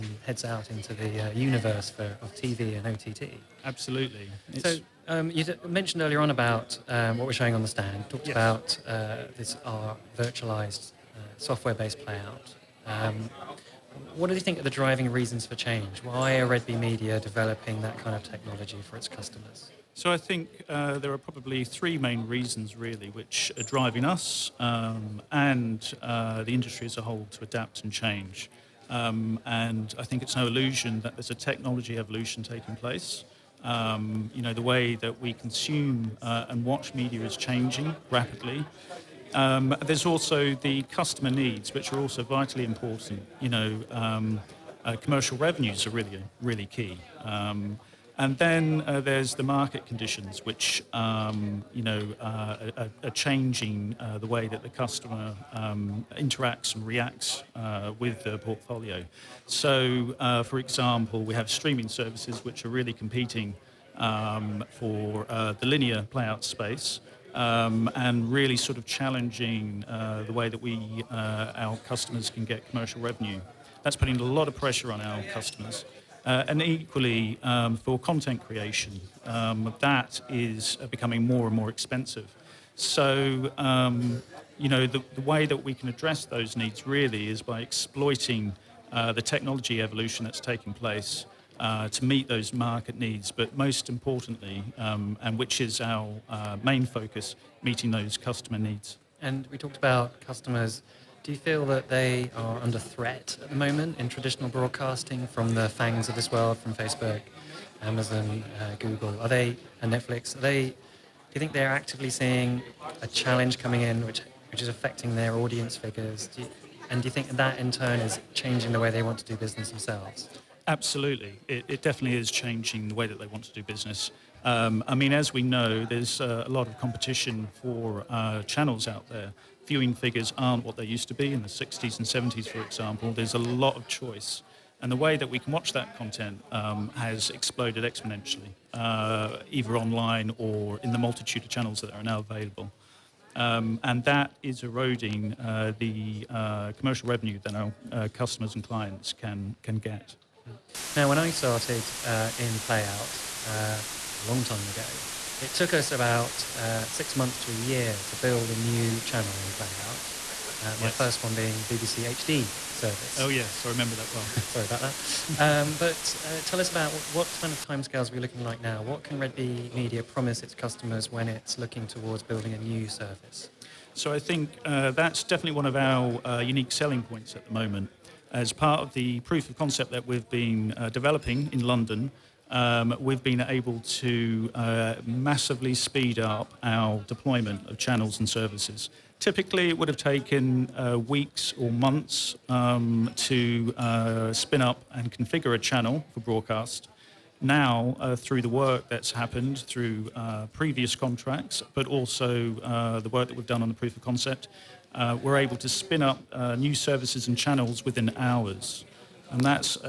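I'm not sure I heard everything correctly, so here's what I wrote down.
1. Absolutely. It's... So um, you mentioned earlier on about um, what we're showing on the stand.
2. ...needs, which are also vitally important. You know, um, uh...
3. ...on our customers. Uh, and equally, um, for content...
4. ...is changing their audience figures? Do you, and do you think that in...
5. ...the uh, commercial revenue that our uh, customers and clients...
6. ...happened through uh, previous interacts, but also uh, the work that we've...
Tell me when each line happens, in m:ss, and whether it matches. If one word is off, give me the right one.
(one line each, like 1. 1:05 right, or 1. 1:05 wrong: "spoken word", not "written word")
1. 0:03 right
2. 0:41 right
3. 1:14 right
4. 1:54 wrong: "affecting", not "changing"
5. 2:25 right
6. 3:19 wrong: "contracts", not "interacts".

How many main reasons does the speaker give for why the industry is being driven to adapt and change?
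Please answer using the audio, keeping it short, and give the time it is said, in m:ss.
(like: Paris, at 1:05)
3, at 0:21.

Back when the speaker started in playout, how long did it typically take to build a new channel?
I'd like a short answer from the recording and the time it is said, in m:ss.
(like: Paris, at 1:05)
6 months to a year, at 2:36.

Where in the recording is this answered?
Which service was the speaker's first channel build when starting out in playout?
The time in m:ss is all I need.
2:41.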